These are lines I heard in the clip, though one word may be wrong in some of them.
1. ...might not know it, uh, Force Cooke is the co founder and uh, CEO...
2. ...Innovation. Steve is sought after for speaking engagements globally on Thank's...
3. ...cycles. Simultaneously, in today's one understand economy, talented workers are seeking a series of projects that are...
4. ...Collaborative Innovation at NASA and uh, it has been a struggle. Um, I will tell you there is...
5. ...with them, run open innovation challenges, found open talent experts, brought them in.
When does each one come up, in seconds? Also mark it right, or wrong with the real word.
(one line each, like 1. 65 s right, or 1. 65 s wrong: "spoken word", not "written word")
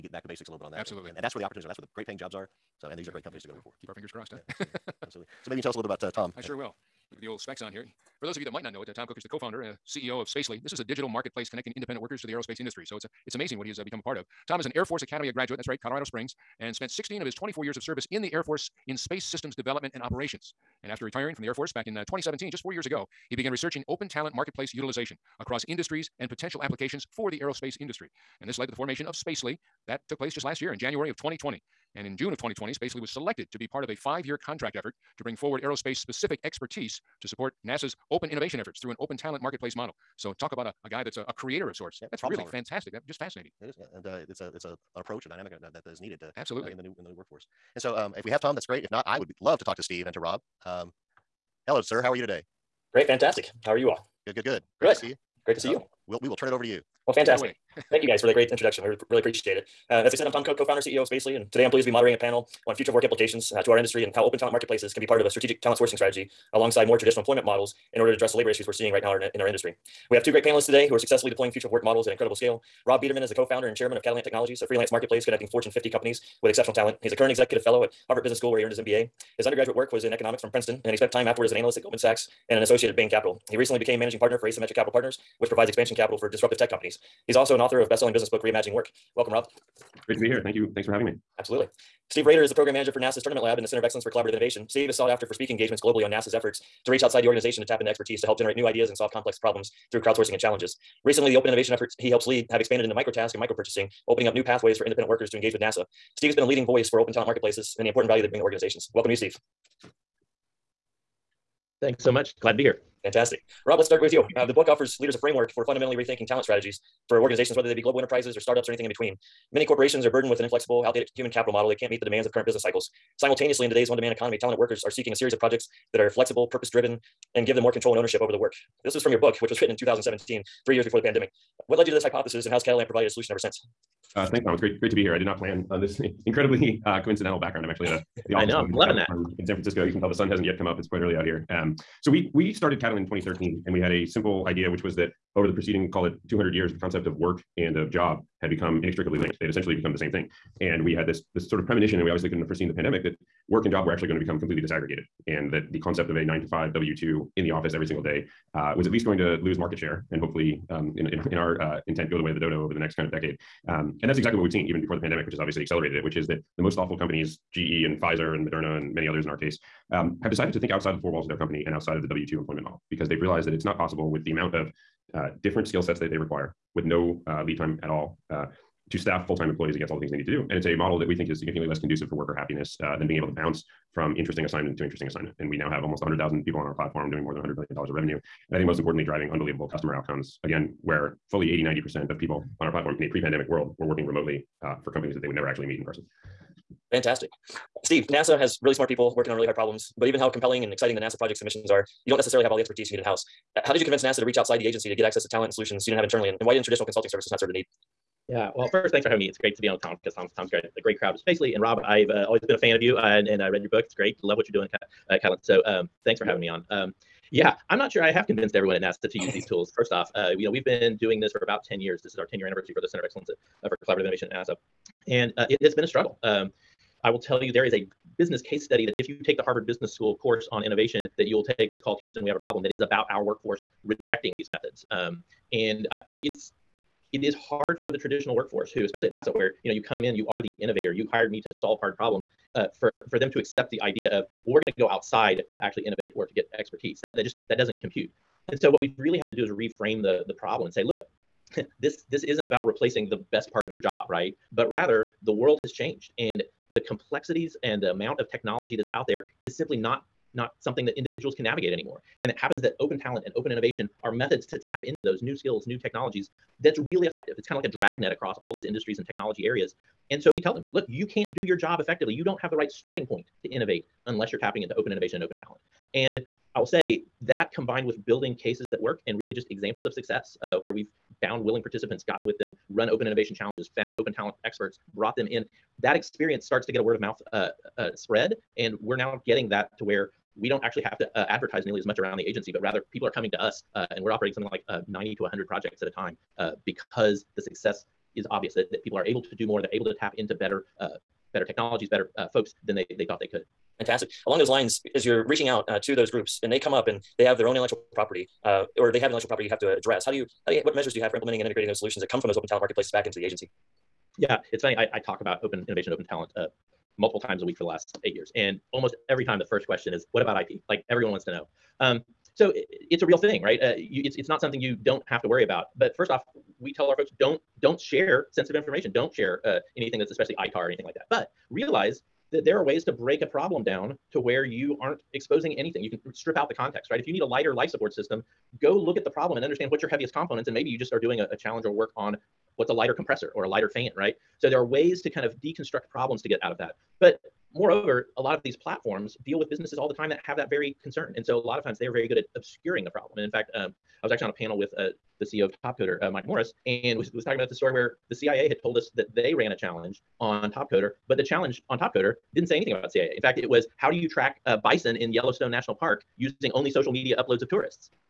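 1. 8 s wrong: "Tom", not "Force"
2. 94 s wrong: "NASA", not "Thank"
3. 122 s wrong: "demand", not "understand"
4. 223 s right
5. 282 s right.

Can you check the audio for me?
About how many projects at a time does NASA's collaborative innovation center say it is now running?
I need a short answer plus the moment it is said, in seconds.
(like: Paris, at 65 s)
90 to 100, at 294 s.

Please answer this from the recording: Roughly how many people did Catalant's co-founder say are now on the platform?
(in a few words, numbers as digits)
100,000.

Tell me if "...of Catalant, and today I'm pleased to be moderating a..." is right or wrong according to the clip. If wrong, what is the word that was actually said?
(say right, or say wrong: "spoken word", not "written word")
wrong: "Spacely", not "Catalant".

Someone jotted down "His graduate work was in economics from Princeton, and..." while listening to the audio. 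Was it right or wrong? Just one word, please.
wrong.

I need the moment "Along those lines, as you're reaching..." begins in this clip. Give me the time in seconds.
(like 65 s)
304 s.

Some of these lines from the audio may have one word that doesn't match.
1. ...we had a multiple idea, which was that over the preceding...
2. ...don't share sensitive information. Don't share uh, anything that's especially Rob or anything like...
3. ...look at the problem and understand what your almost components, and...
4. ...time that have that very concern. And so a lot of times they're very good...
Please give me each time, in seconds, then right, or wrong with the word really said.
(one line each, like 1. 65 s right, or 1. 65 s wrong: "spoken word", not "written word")
1. 143 s wrong: "simple", not "multiple"
2. 327 s wrong: "ITAR", not "Rob"
3. 338 s wrong: "heaviest", not "almost"
4. 349 s right.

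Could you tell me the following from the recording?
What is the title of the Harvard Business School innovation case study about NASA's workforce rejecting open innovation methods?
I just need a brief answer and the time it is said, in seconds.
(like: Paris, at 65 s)
Houston, we have a problem, at 232 s.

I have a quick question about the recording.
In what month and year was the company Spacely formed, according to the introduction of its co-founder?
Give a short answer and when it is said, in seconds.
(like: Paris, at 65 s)
January 2020, at 30 s.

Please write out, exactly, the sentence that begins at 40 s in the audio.
So talk about a, a guy that's a, a creator of sorts.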